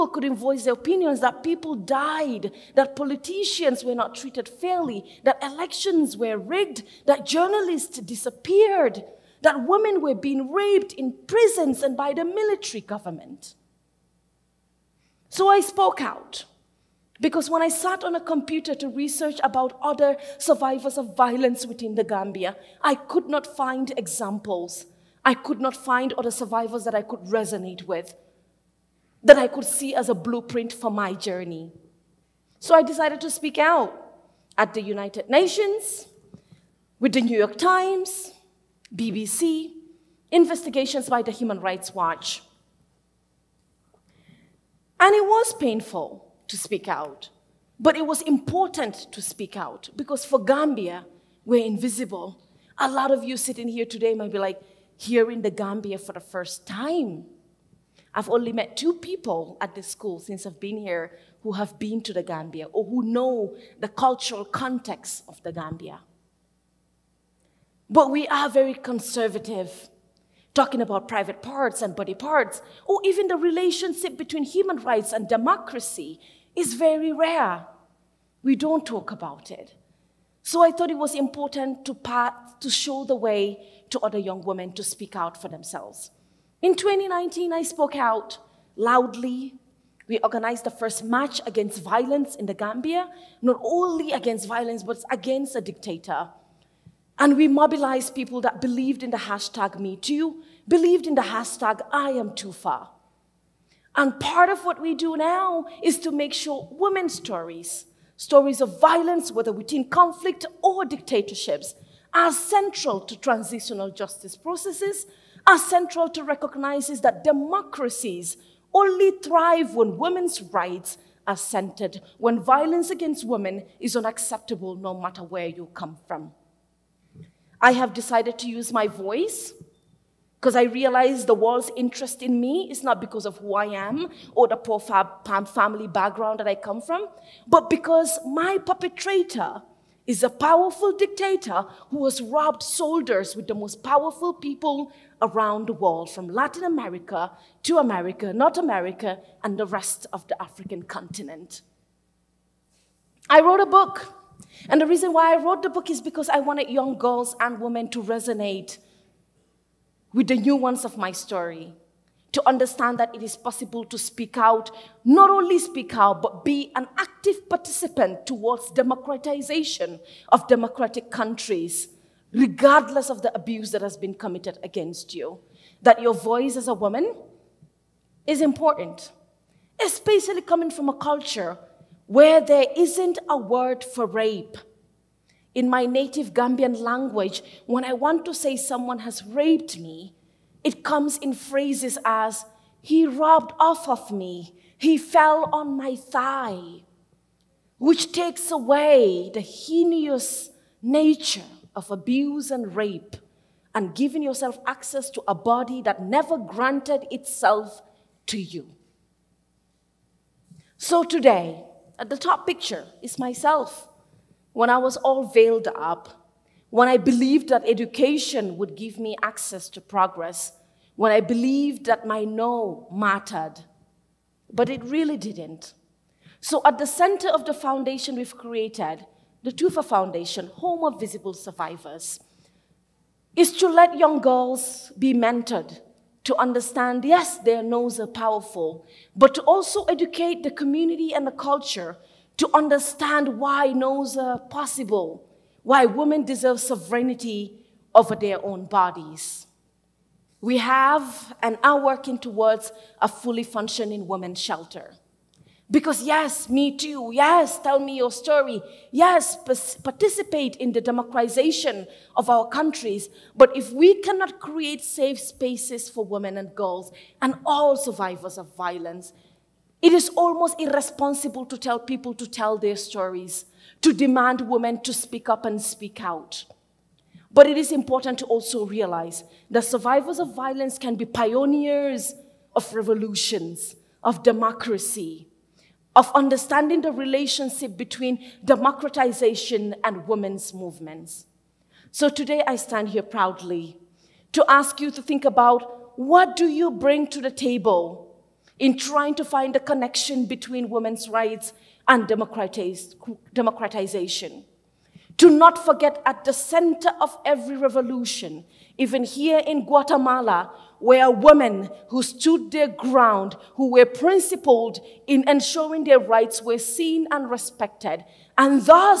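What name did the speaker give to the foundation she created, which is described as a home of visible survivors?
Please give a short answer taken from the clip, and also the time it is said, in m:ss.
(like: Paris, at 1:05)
Toufah Foundation, at 3:49.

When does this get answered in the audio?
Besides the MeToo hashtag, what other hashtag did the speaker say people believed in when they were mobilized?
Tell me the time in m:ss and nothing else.
1:41.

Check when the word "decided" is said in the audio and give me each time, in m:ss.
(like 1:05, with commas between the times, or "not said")
0:32, 2:07.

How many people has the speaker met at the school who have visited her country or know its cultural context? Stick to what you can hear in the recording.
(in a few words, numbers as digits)
2.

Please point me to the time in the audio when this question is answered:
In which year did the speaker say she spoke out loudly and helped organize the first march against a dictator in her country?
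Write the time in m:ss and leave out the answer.
1:26.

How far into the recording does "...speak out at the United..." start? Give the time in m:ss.
0:33.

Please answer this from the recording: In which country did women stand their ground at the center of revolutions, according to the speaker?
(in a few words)
Guatemala.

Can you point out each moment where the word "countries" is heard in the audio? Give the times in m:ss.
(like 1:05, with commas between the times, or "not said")
2:51, 4:22.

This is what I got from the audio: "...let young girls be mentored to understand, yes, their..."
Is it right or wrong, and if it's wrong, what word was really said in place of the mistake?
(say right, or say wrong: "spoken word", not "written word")
right.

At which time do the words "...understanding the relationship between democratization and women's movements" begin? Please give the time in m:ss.
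4:46.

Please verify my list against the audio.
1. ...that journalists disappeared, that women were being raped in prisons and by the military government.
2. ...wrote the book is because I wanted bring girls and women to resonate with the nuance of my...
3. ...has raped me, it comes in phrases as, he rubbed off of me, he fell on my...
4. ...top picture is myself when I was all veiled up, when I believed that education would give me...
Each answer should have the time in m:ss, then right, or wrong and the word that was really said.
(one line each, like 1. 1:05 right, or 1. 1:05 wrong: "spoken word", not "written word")
1. 0:07 right
2. 2:35 wrong: "young", not "bring"
3. 3:08 right
4. 3:32 right.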